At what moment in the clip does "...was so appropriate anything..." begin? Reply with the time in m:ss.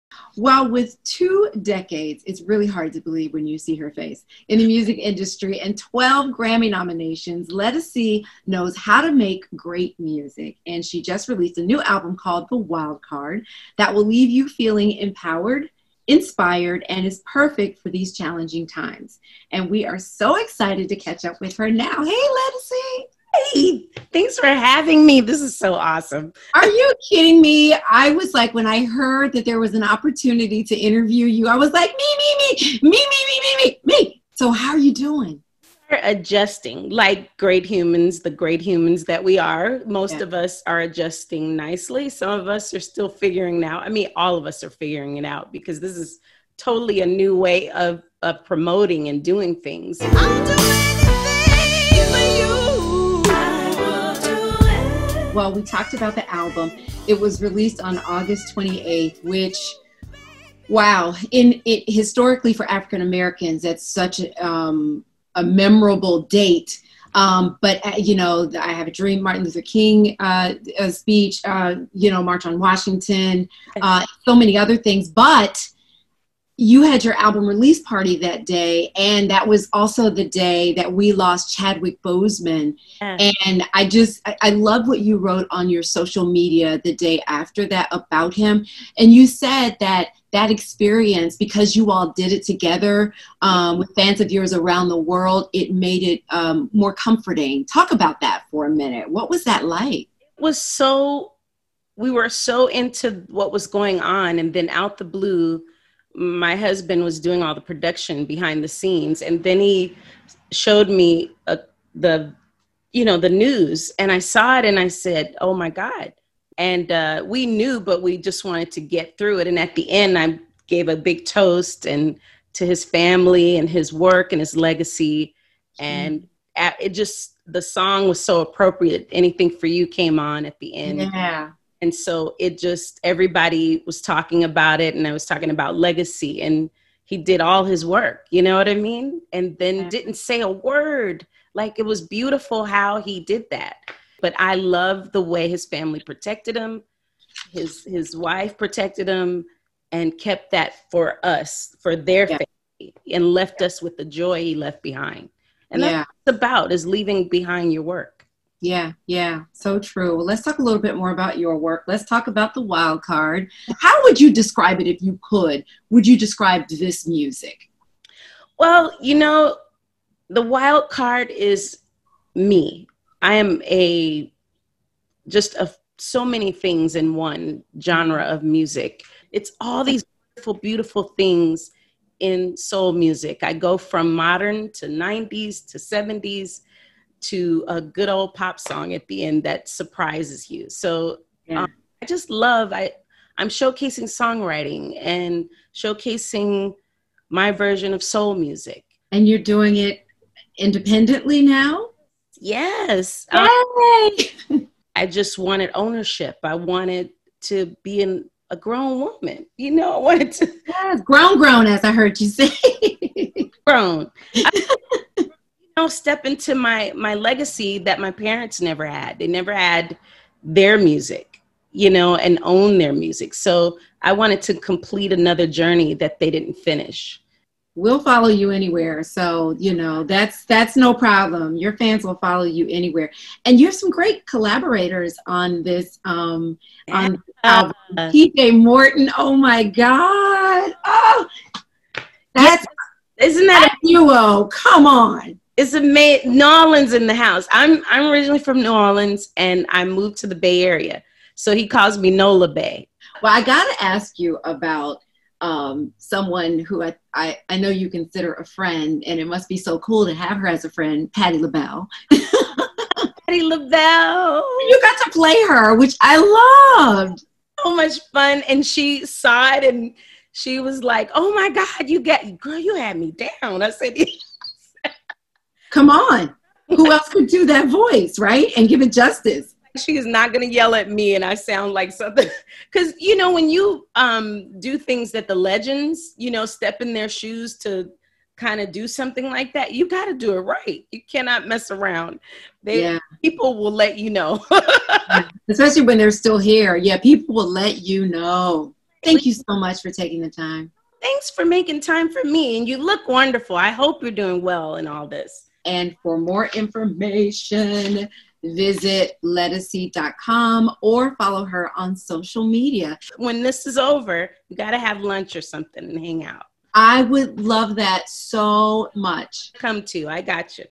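2:08.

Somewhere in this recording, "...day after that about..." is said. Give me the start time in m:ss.
1:26.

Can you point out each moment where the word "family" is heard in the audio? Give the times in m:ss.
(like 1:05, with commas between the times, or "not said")
2:02, 2:25, 2:32.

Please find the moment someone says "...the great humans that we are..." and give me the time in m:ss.
0:38.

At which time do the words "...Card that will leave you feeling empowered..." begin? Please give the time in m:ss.
0:13.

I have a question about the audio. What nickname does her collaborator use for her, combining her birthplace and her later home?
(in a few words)
Nola Bay.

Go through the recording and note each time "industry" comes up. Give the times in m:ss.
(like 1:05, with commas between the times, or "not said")
0:04.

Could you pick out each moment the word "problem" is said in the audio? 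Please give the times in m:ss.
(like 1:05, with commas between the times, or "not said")
3:50.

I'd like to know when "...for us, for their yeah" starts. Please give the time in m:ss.
2:30.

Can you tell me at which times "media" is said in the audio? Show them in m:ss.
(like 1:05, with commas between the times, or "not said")
1:26, 5:12.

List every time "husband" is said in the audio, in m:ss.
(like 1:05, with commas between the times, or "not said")
1:46.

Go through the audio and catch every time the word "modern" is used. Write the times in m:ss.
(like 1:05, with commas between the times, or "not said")
3:04.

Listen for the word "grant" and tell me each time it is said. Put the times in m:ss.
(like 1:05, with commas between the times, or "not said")
not said.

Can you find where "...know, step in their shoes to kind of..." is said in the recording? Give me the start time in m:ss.
4:46.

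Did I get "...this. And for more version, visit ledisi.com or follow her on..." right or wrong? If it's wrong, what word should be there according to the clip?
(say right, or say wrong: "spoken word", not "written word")
wrong: "information", not "version".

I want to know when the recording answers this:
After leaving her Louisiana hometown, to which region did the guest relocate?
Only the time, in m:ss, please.
4:10.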